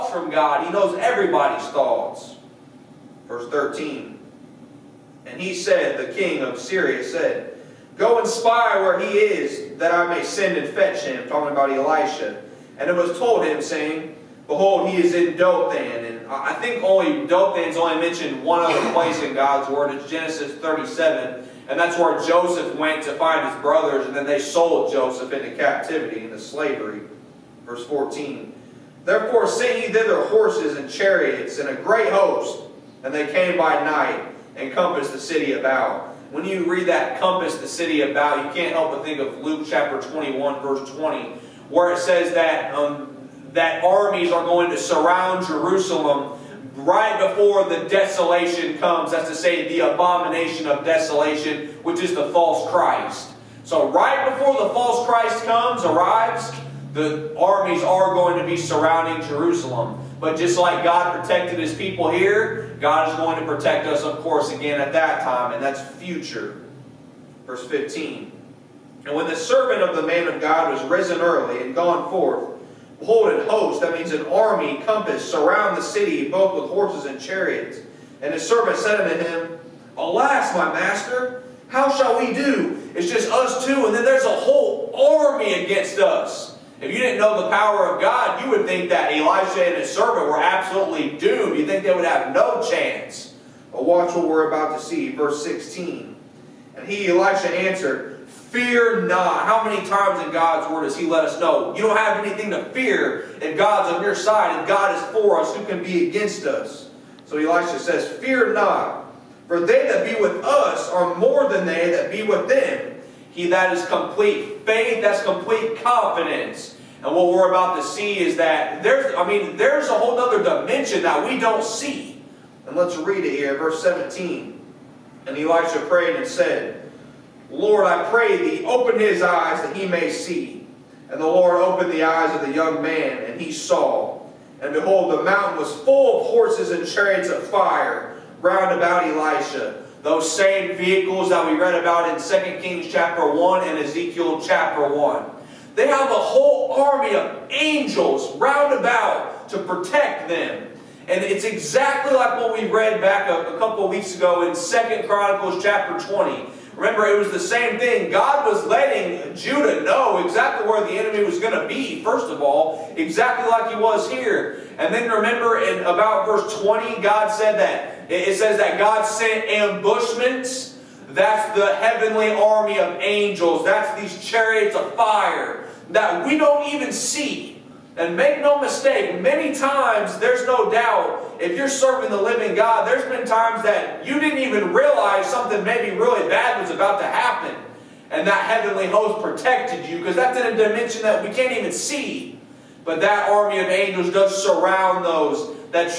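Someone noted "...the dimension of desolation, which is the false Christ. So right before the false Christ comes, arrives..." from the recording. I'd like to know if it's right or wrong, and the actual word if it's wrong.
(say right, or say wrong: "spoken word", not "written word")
wrong: "abomination", not "dimension".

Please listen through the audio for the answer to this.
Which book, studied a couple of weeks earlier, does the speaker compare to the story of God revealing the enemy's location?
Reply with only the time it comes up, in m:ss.
2:34.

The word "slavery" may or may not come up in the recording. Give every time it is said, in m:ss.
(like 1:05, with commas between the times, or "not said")
0:26.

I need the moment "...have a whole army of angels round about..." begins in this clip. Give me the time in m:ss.
2:25.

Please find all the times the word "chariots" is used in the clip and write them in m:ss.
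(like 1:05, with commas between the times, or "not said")
0:30, 1:17, 2:16, 2:54.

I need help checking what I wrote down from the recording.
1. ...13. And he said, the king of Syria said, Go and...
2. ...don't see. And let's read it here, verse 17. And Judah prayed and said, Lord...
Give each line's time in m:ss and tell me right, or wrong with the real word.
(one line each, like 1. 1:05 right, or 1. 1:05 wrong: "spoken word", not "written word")
1. 0:03 right
2. 2:01 wrong: "Elisha", not "Judah".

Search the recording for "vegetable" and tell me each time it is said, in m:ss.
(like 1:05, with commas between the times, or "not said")
not said.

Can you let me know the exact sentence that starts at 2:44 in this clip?
And then remember, in about verse 20, God said that it says that God sent ambushments.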